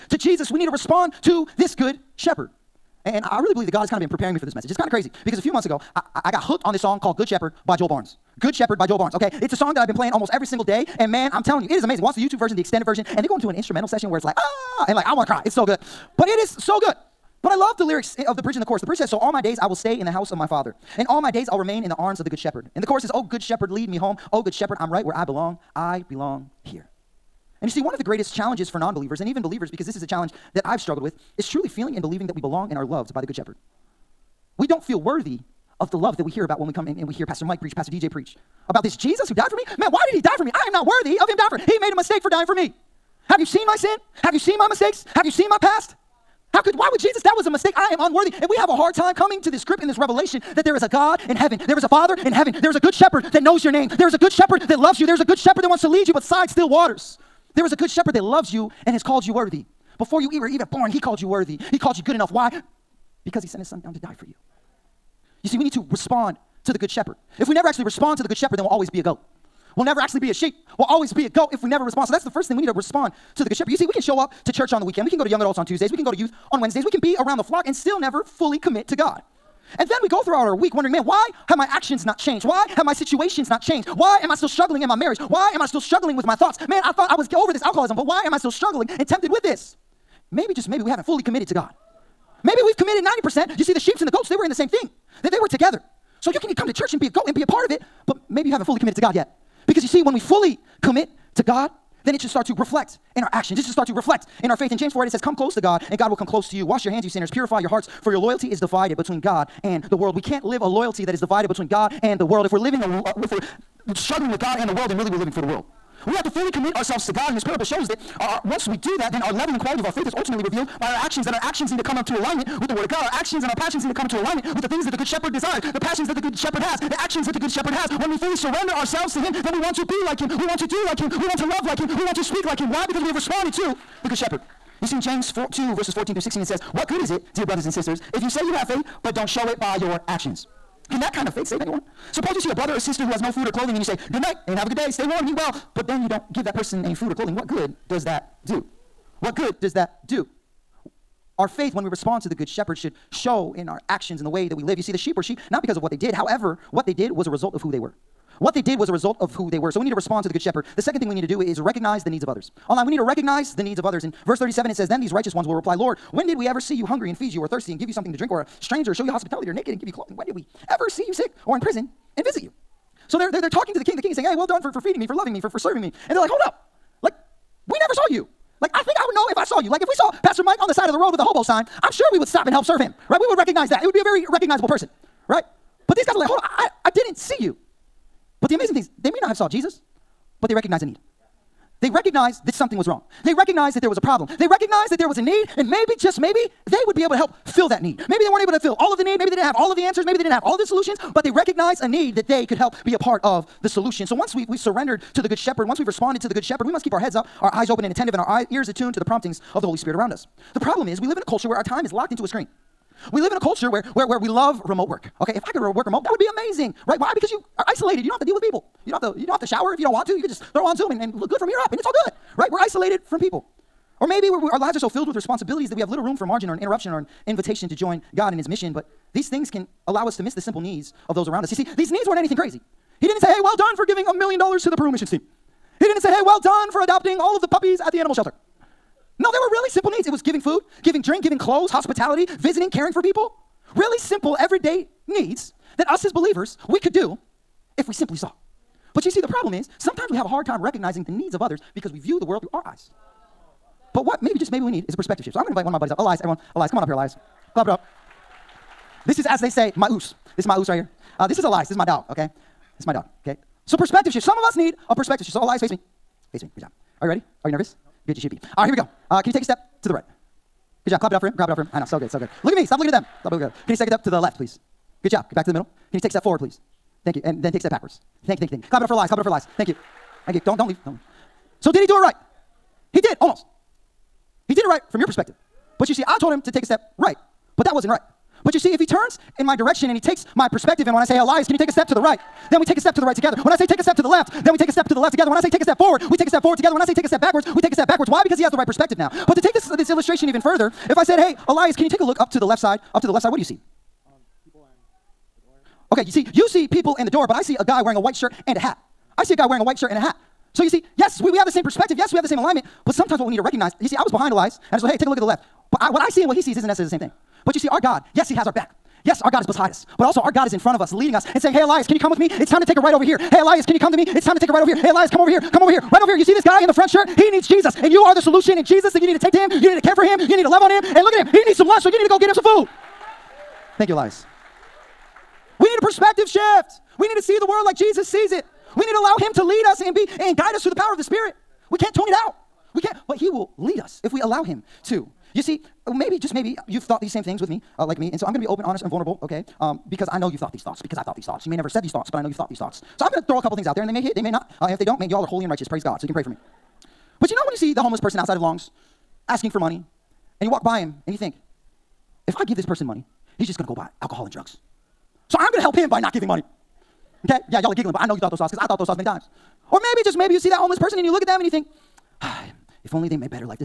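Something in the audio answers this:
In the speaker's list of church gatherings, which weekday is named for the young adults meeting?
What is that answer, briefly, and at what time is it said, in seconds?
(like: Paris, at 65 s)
Tuesdays, at 75 s.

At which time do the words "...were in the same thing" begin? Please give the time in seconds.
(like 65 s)
94 s.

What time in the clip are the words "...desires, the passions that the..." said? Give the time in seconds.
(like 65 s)
125 s.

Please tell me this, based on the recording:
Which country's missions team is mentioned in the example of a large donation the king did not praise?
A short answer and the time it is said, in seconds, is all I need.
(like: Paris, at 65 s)
Peru, at 234 s.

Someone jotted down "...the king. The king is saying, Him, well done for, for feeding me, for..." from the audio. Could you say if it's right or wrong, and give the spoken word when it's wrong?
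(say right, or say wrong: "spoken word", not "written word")
wrong: "Hey", not "Him".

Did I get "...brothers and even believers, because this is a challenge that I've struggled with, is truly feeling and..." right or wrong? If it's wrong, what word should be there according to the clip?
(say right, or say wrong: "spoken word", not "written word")
wrong: "believers", not "brothers".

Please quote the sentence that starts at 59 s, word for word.
Before you were even born, he called you worthy.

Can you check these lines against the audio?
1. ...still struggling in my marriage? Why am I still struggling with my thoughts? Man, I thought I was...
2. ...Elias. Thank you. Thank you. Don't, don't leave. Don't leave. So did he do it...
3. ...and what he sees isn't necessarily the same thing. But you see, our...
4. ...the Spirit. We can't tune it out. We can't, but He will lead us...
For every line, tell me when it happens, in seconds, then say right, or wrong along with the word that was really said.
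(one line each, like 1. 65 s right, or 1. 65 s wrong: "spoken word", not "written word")
1. 84 s right
2. 279 s right
3. 316 s right
4. 340 s right.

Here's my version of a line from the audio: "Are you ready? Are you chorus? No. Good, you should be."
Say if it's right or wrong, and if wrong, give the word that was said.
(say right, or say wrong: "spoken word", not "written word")
wrong: "nervous", not "chorus".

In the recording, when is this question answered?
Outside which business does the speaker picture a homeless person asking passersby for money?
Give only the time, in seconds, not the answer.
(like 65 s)
358 s.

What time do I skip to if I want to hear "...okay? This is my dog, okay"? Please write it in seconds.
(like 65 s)
262 s.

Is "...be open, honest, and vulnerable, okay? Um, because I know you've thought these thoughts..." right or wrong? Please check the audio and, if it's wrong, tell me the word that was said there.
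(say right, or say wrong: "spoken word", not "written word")
right.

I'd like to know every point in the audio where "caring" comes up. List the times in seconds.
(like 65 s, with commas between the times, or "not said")
242 s.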